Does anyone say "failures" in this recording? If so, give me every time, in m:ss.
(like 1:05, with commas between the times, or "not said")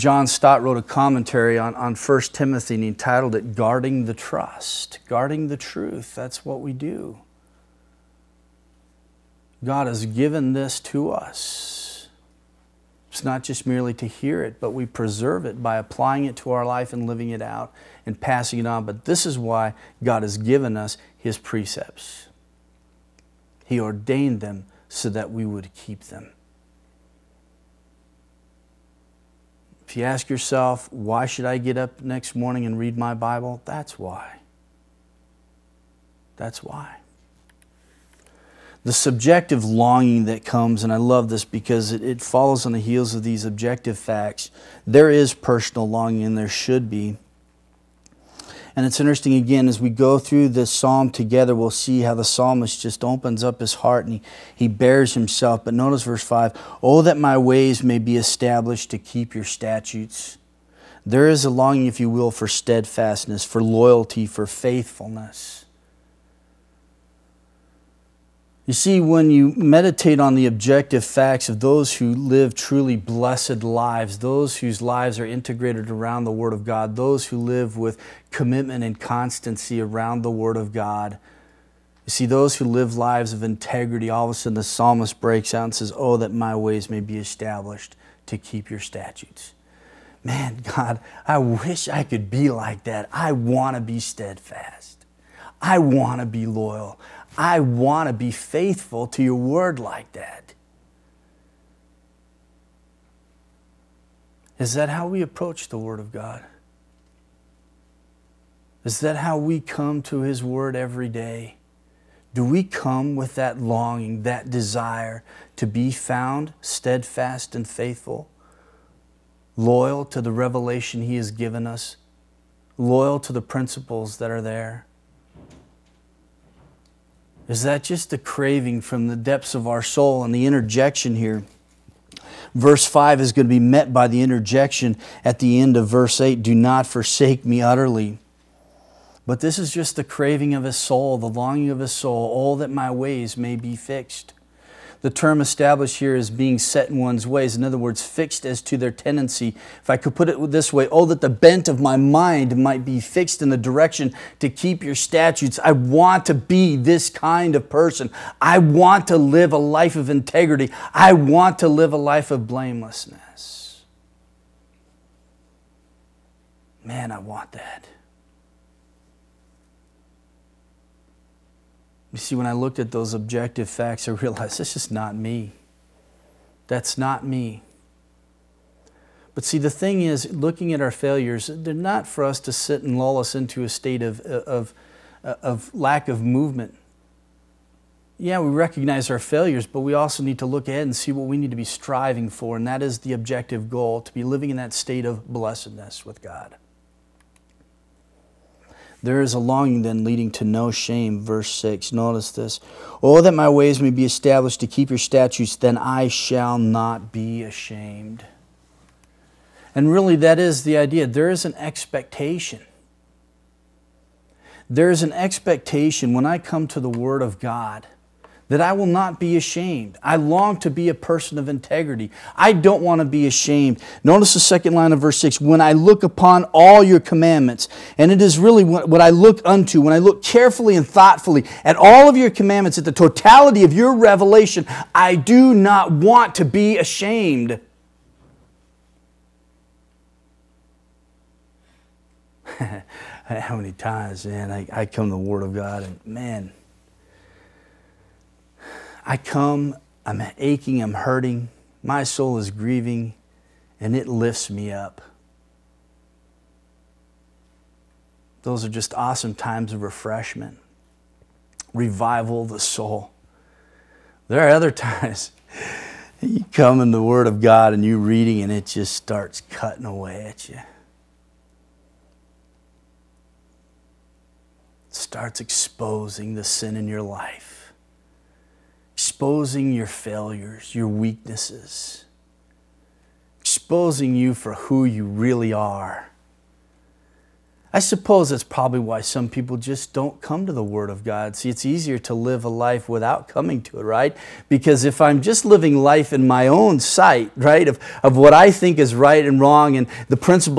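3:00, 3:09, 4:39.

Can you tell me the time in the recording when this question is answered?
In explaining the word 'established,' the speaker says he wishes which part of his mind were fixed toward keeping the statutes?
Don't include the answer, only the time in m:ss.
2:31.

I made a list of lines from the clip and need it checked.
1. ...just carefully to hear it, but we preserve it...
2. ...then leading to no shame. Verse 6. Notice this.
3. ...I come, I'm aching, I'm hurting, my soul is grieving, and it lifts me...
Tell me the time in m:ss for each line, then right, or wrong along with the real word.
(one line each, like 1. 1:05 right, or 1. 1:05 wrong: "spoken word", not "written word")
1. 0:13 wrong: "merely", not "carefully"
2. 3:19 right
3. 4:09 right.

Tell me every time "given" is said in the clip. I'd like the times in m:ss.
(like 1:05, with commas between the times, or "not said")
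0:10, 0:20, 2:01.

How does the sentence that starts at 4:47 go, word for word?
I suppose that's probably why some people just don't come to the Word of God.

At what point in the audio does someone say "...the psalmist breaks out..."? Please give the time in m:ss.
1:24.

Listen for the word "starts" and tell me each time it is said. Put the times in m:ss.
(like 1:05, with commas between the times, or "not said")
4:28, 4:34.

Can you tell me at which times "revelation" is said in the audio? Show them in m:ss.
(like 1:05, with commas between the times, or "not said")
2:00, 3:53.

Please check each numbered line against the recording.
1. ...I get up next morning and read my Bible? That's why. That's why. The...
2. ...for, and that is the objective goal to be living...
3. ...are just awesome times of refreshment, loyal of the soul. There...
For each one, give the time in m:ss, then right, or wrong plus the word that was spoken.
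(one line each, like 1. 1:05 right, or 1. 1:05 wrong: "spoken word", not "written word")
1. 0:31 right
2. 3:12 right
3. 4:18 wrong: "revival", not "loyal".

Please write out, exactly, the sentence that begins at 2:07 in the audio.
Is that just a craving from the depths of our soul and the interjection here?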